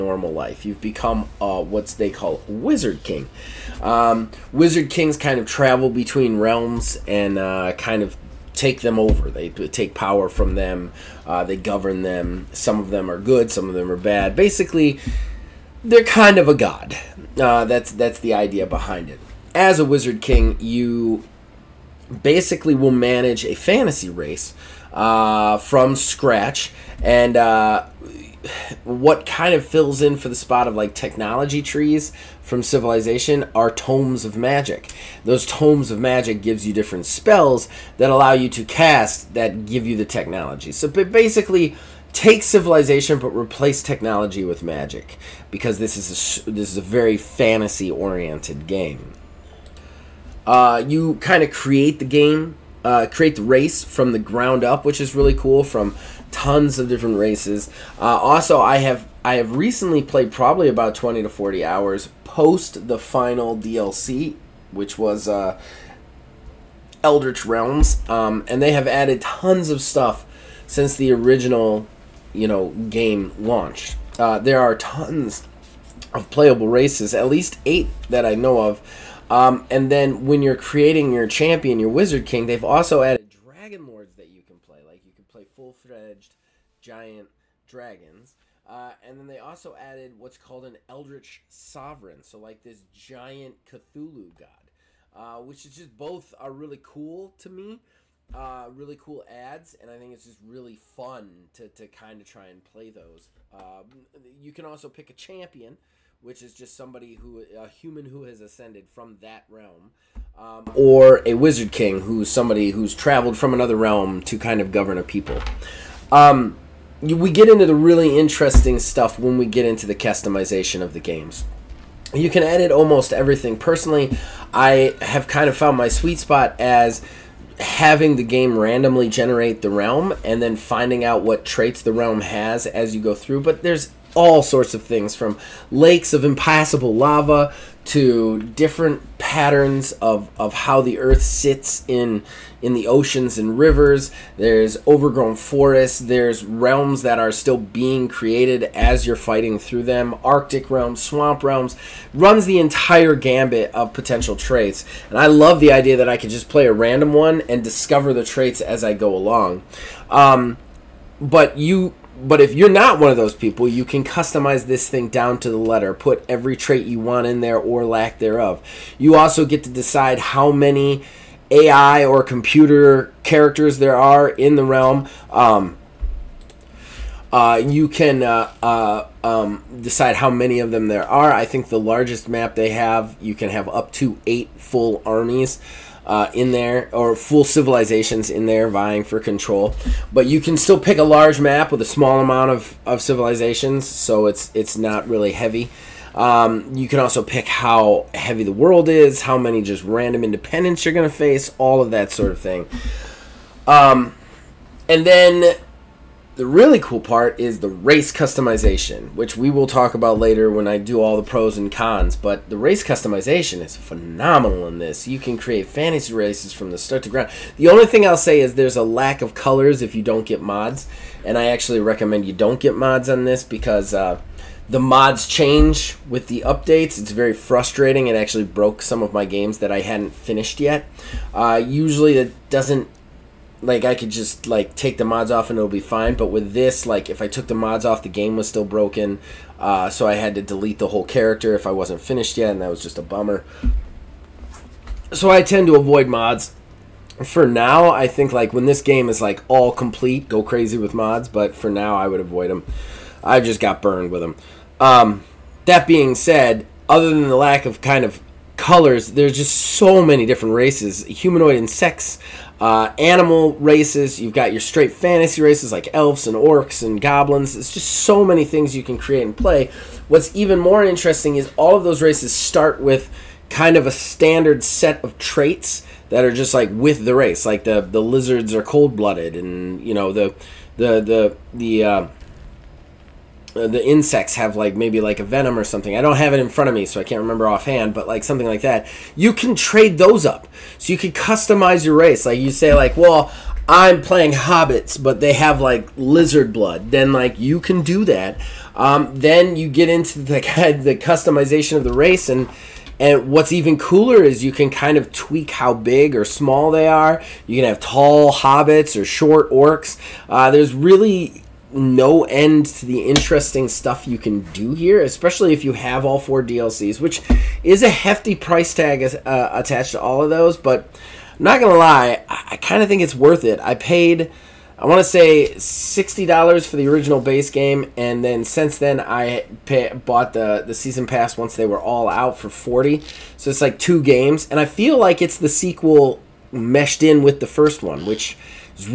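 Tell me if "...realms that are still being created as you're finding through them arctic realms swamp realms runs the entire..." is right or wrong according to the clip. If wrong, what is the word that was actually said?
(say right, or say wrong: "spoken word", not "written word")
wrong: "fighting", not "finding".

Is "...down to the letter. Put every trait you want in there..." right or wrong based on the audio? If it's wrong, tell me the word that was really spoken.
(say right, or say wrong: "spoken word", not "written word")
right.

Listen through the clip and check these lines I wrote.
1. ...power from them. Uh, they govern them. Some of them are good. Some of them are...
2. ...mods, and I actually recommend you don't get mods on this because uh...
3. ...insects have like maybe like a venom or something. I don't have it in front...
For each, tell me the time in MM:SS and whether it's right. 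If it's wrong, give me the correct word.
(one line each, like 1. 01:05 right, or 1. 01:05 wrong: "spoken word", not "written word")
1. 00:09 right
2. 03:40 right
3. 04:43 right.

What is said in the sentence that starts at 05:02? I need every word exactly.
And what's even cooler is you can kind of tweak how big or small they are.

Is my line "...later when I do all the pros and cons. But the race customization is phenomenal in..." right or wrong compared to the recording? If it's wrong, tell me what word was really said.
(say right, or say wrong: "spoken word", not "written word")
right.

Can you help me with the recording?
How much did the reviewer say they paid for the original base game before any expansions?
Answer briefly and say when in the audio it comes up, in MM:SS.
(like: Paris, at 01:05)
$60, at 05:25.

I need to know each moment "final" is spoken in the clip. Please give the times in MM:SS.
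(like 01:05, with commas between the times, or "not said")
01:02.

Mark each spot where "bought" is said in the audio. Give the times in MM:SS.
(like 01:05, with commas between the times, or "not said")
05:29.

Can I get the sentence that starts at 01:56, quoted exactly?
Um, we get into the really interesting stuff when we get into the customization of the games you can edit almost everything.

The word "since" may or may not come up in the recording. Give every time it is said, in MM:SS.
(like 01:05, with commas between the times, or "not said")
01:10, 05:28.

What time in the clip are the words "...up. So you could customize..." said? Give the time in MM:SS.
04:50.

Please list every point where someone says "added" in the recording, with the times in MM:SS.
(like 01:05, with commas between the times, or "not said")
01:08, 01:23, 01:29.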